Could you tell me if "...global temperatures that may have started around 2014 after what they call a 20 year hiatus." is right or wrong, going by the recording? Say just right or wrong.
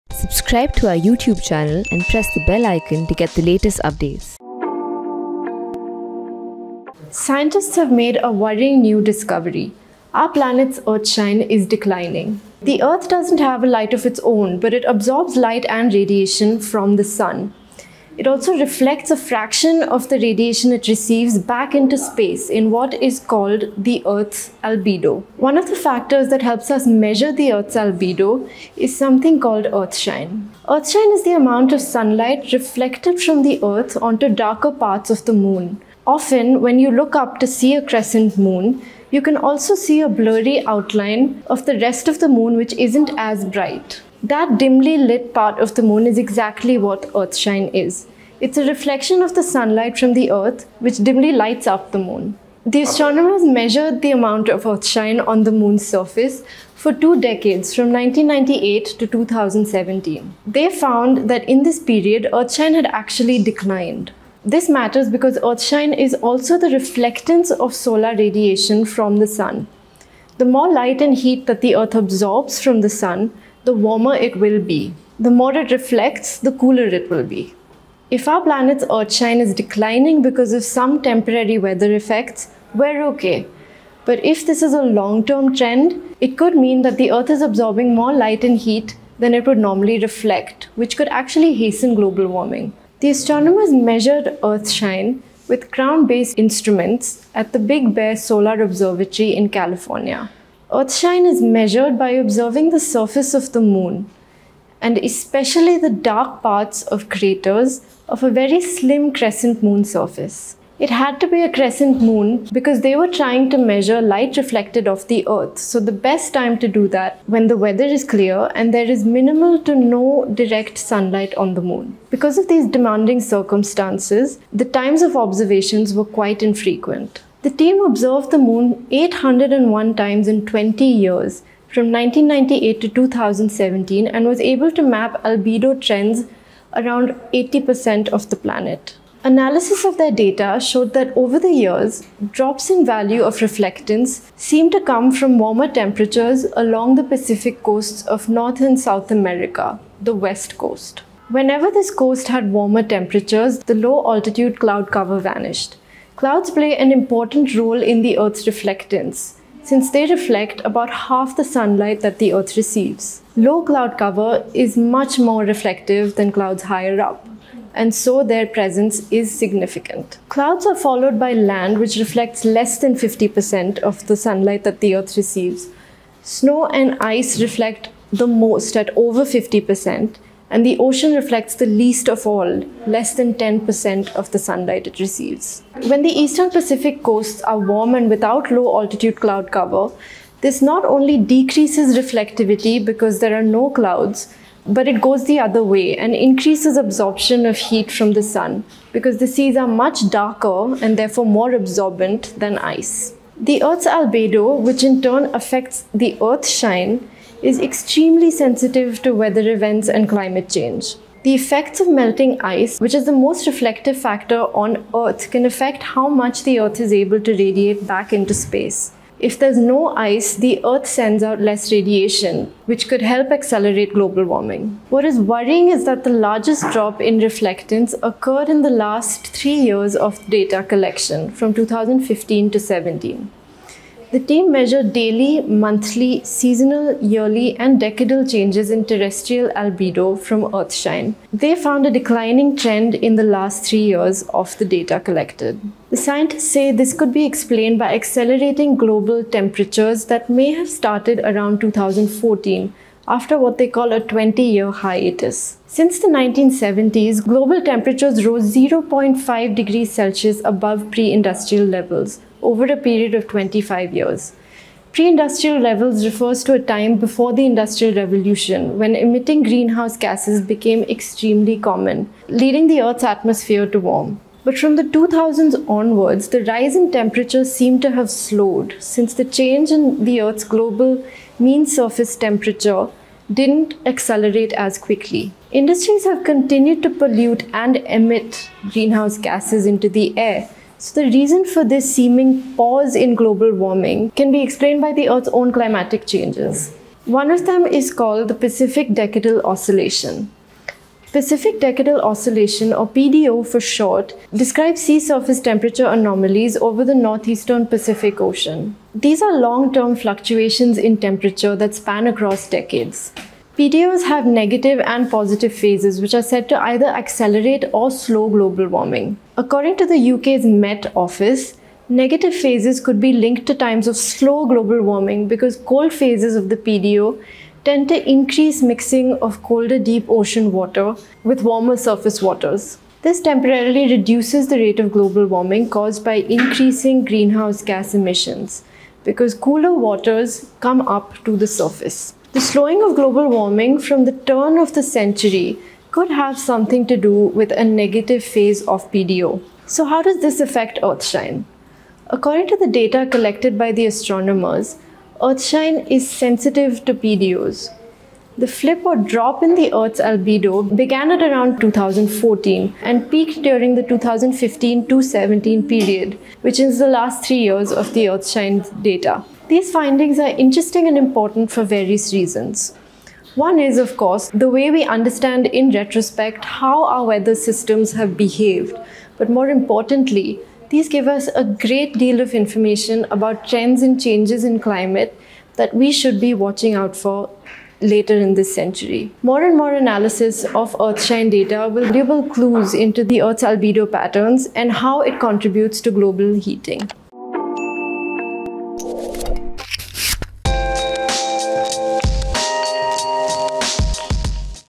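right.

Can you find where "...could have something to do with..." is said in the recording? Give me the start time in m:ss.
5:45.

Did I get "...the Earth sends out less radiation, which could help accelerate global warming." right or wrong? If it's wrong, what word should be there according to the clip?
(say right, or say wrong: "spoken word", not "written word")
right.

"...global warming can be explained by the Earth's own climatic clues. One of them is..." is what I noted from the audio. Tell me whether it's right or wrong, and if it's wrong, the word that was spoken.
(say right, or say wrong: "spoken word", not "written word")
wrong: "changes", not "clues".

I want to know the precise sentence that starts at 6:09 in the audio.
These findings are interesting and important for various reasons.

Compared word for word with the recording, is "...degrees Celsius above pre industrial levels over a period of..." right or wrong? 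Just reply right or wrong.
right.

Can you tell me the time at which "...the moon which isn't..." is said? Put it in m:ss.
0:42.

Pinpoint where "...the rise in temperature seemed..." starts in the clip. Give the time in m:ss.
4:36.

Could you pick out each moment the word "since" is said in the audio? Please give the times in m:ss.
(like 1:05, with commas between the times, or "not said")
2:39, 4:15, 4:38.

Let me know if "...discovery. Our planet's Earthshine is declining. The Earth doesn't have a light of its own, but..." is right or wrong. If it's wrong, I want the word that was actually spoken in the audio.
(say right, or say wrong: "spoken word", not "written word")
right.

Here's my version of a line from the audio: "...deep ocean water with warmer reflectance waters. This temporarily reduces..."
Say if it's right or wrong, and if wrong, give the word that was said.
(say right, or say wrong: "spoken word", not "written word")
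wrong: "surface", not "reflectance".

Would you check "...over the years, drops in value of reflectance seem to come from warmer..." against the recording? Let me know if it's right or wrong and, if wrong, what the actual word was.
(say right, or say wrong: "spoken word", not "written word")
right.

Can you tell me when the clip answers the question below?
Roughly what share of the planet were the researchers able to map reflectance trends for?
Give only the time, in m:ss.
2:17.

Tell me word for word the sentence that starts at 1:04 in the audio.
This matters because Earthshine is also the reflectance of solar radiation from the sun.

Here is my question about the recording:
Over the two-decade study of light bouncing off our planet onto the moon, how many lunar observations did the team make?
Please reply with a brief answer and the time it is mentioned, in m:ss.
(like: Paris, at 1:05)
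801, at 2:08.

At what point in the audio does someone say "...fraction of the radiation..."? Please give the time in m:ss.
0:19.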